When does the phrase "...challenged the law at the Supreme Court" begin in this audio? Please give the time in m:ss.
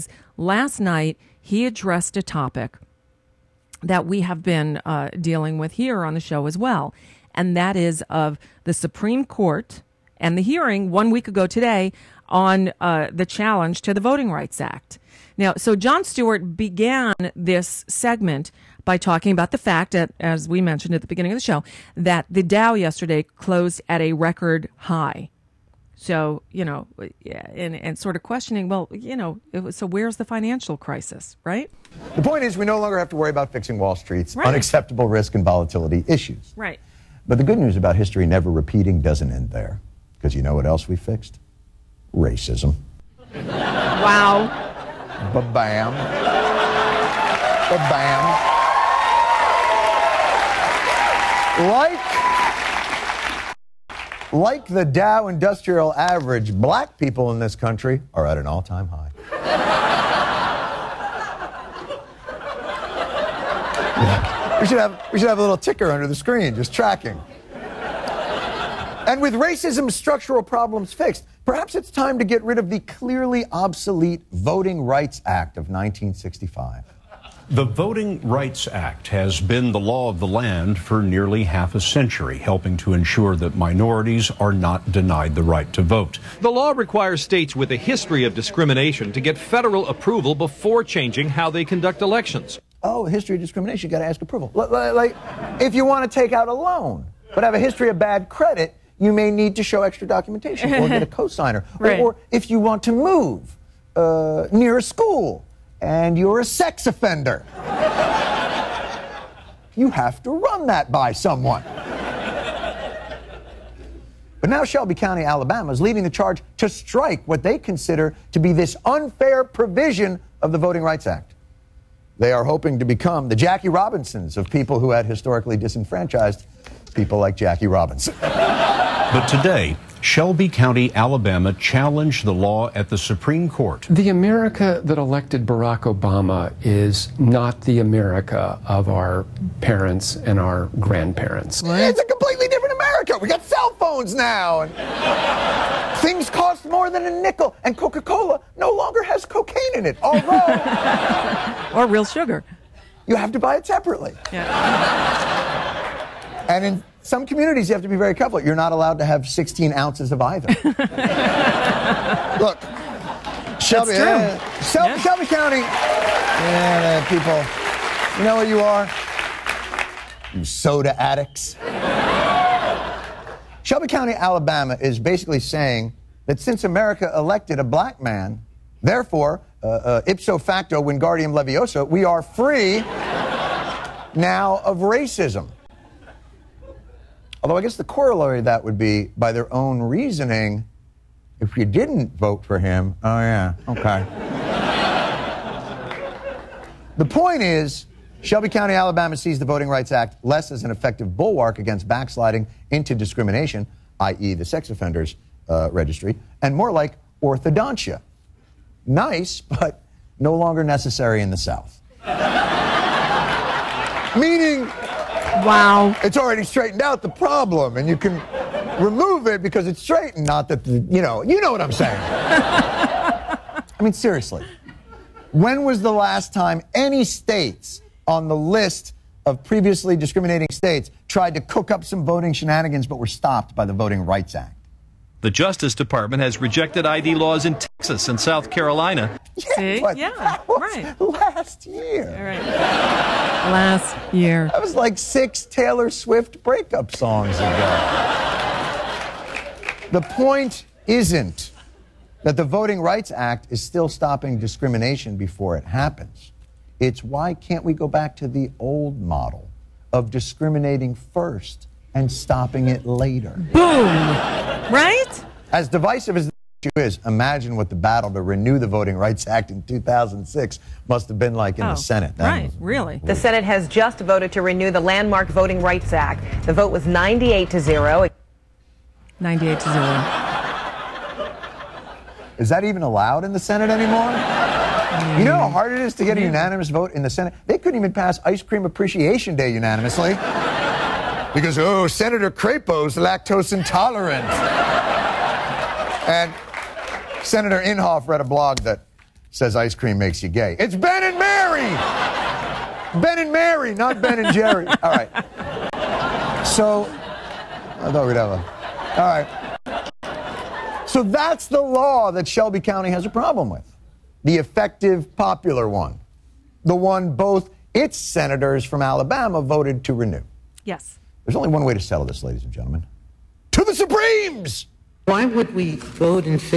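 2:11.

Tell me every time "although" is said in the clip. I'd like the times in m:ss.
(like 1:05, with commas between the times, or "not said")
2:30, 3:07.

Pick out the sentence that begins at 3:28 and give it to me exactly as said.
Nice, but no longer necessary in the South.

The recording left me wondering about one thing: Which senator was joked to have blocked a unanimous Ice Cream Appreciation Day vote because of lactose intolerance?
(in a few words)
Senator Crapo.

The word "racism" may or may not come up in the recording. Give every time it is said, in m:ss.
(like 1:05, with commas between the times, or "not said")
0:42, 1:09, 3:04.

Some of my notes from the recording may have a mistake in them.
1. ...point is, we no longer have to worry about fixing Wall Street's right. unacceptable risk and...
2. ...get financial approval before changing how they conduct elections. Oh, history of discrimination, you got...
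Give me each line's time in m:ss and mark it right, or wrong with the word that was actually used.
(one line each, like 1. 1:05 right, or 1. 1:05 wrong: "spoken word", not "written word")
1. 0:32 right
2. 1:29 wrong: "federal", not "financial".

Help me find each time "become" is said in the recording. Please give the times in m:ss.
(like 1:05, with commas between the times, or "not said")
2:02.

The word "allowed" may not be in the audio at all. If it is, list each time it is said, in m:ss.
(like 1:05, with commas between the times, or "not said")
2:38, 4:42.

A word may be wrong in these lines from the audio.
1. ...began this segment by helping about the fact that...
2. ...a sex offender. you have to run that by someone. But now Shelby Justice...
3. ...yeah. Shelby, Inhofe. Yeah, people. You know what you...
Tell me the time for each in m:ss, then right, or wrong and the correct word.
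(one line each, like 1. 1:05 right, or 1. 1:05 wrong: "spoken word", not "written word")
1. 0:16 wrong: "talking", not "helping"
2. 1:46 wrong: "County", not "Justice"
3. 2:44 wrong: "County", not "Inhofe".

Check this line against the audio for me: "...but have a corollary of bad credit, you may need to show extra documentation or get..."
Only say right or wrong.
wrong.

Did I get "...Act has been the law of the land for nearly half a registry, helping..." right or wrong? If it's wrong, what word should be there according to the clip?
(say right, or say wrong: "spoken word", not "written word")
wrong: "century", not "registry".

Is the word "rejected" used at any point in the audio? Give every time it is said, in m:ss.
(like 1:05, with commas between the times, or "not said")
3:56.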